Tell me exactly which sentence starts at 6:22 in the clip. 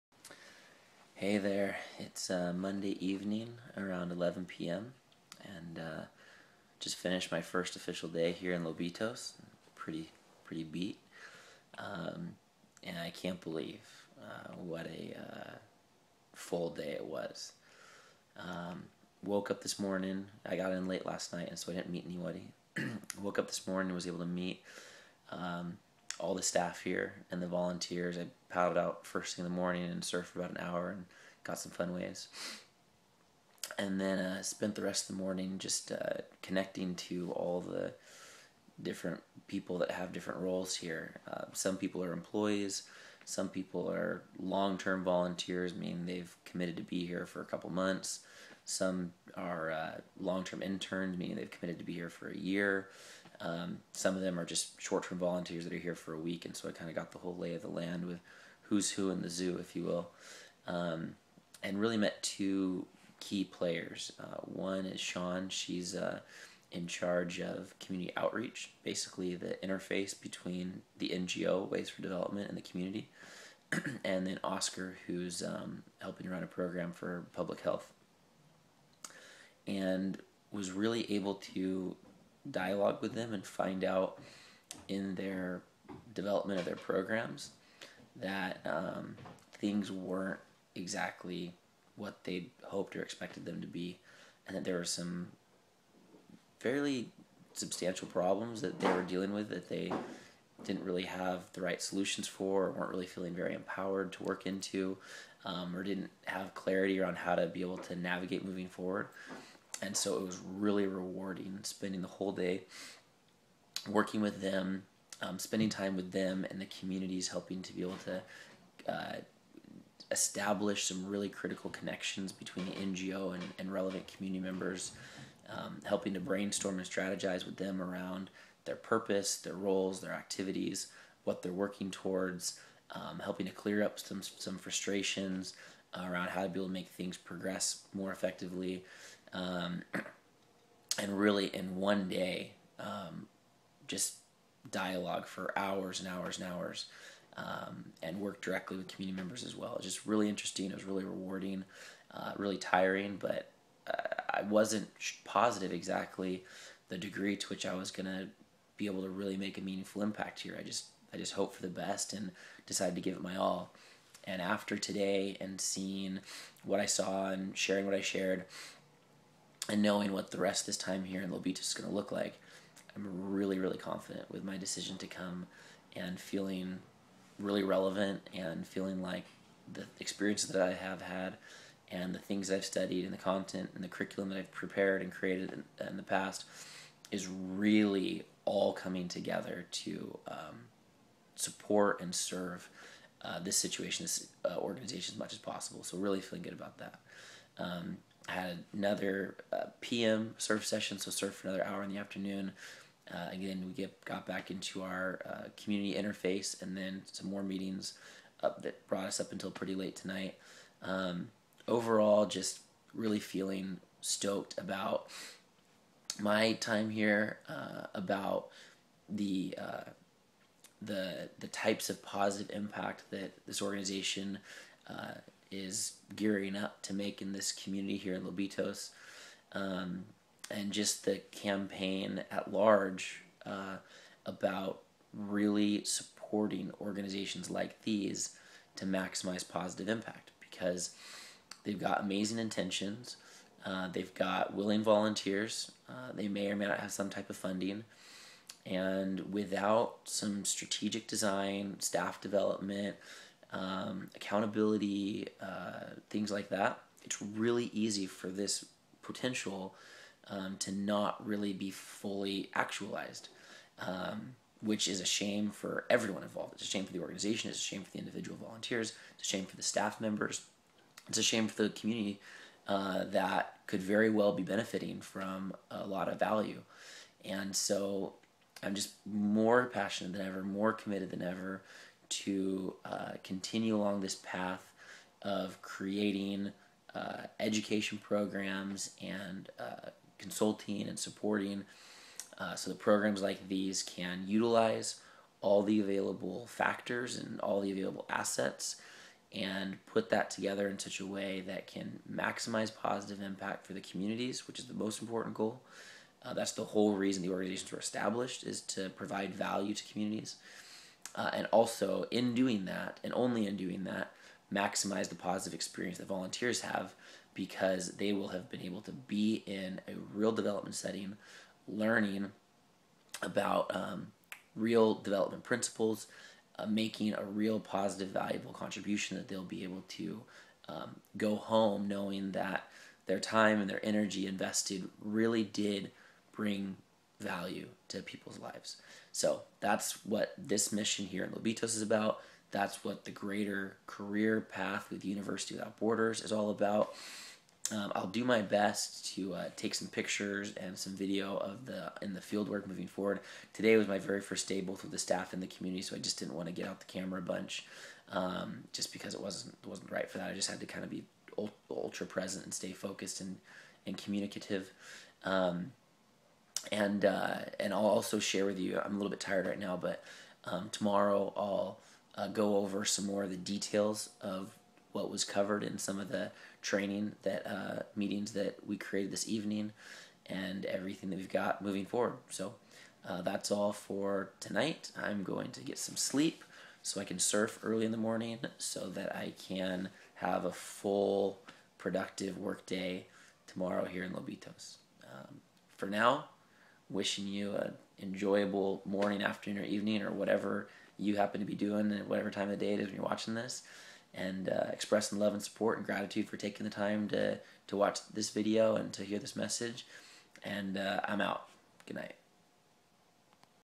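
So uh, that's all for tonight.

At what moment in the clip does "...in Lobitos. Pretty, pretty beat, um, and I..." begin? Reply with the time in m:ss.
0:08.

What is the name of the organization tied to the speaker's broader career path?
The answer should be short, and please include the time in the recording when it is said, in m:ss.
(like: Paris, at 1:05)
University Without Borders, at 5:45.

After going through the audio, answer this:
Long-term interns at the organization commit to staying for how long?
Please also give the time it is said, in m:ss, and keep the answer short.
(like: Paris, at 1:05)
A year, at 0:52.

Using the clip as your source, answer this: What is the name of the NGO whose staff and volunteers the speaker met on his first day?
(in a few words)
Ways for Development.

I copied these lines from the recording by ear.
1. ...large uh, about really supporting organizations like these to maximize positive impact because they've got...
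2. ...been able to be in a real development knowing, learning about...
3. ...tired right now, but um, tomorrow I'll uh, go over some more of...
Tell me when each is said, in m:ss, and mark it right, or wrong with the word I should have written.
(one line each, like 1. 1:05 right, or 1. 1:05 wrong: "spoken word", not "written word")
1. 3:52 right
2. 5:18 wrong: "setting", not "knowing"
3. 6:09 right.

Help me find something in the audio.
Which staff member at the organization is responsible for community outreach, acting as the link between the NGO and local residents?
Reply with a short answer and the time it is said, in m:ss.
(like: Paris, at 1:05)
Sean, at 1:04.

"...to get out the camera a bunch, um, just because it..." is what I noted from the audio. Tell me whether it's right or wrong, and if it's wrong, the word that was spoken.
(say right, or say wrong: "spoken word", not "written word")
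right.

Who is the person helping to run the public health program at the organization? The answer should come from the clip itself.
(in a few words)
Oscar.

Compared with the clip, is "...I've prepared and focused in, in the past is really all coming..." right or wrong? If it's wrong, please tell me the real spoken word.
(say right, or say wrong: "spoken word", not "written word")
wrong: "created", not "focused".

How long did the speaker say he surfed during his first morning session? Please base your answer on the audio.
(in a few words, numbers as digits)
About an hour.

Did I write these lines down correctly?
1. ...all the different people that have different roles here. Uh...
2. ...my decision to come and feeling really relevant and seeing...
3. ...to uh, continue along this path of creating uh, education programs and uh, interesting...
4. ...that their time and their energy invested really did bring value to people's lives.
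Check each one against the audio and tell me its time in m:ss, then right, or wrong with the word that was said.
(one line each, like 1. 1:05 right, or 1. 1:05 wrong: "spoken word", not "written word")
1. 0:37 right
2. 2:54 wrong: "feeling", not "seeing"
3. 4:42 wrong: "consulting", not "interesting"
4. 5:32 right.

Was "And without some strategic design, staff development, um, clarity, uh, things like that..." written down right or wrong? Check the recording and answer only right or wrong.
wrong.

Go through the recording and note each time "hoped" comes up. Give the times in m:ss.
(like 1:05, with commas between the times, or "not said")
1:32, 2:41.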